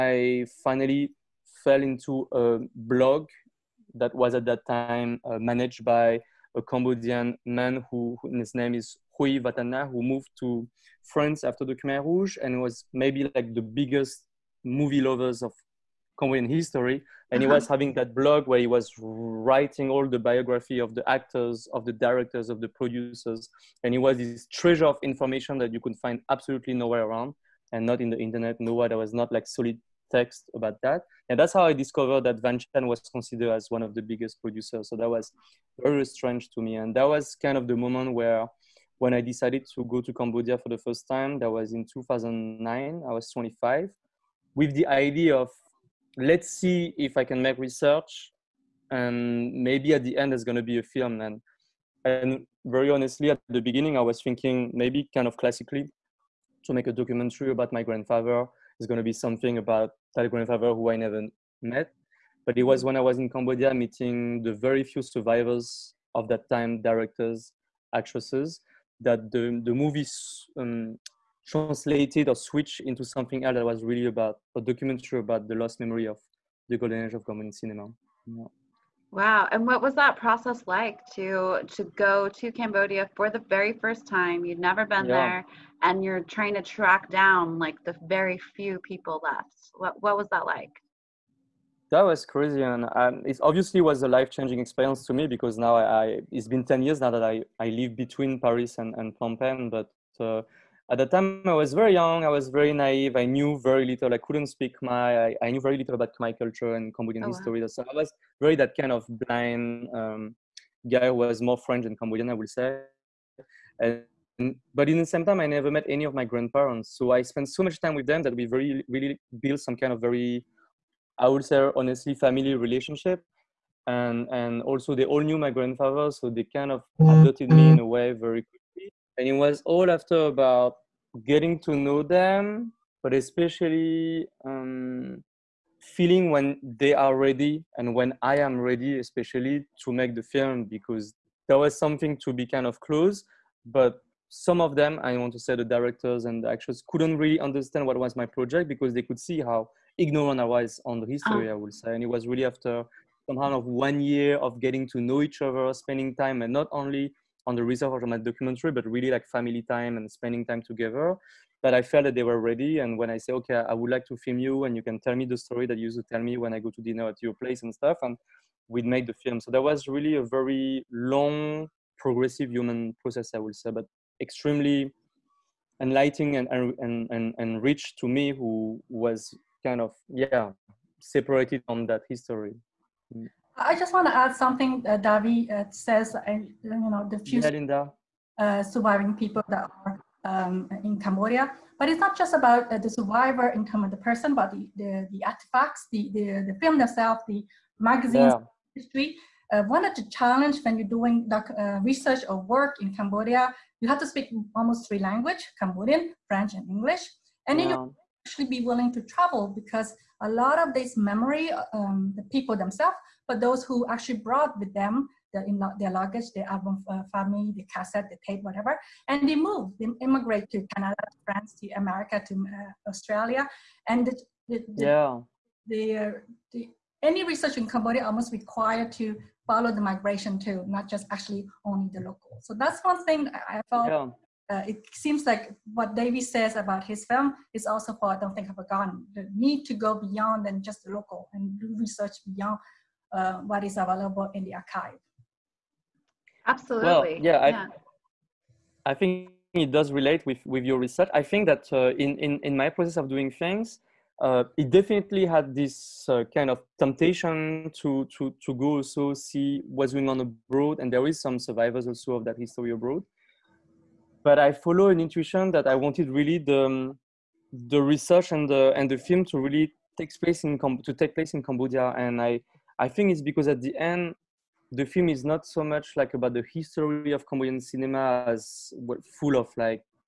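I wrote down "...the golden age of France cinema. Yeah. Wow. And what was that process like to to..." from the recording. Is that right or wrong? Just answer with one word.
wrong.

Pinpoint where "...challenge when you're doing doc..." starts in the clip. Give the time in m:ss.
3:20.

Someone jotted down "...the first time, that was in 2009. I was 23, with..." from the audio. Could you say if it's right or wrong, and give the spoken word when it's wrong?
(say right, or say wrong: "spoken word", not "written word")
wrong: "25", not "23".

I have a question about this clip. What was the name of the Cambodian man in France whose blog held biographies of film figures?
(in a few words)
Rui Vatana.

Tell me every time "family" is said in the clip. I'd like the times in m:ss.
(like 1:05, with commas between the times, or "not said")
2:02, 2:39, 3:37.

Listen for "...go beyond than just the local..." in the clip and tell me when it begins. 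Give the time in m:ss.
3:59.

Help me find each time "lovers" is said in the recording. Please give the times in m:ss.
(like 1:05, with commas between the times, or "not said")
0:14.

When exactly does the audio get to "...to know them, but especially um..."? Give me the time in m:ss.
2:11.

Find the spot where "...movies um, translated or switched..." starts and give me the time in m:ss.
1:09.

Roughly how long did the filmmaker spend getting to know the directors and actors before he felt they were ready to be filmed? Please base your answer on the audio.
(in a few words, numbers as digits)
1 year.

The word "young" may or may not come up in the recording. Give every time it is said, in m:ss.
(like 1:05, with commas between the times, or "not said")
1:41.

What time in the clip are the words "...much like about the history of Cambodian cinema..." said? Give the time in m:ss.
4:35.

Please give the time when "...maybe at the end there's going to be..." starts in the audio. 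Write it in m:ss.
0:49.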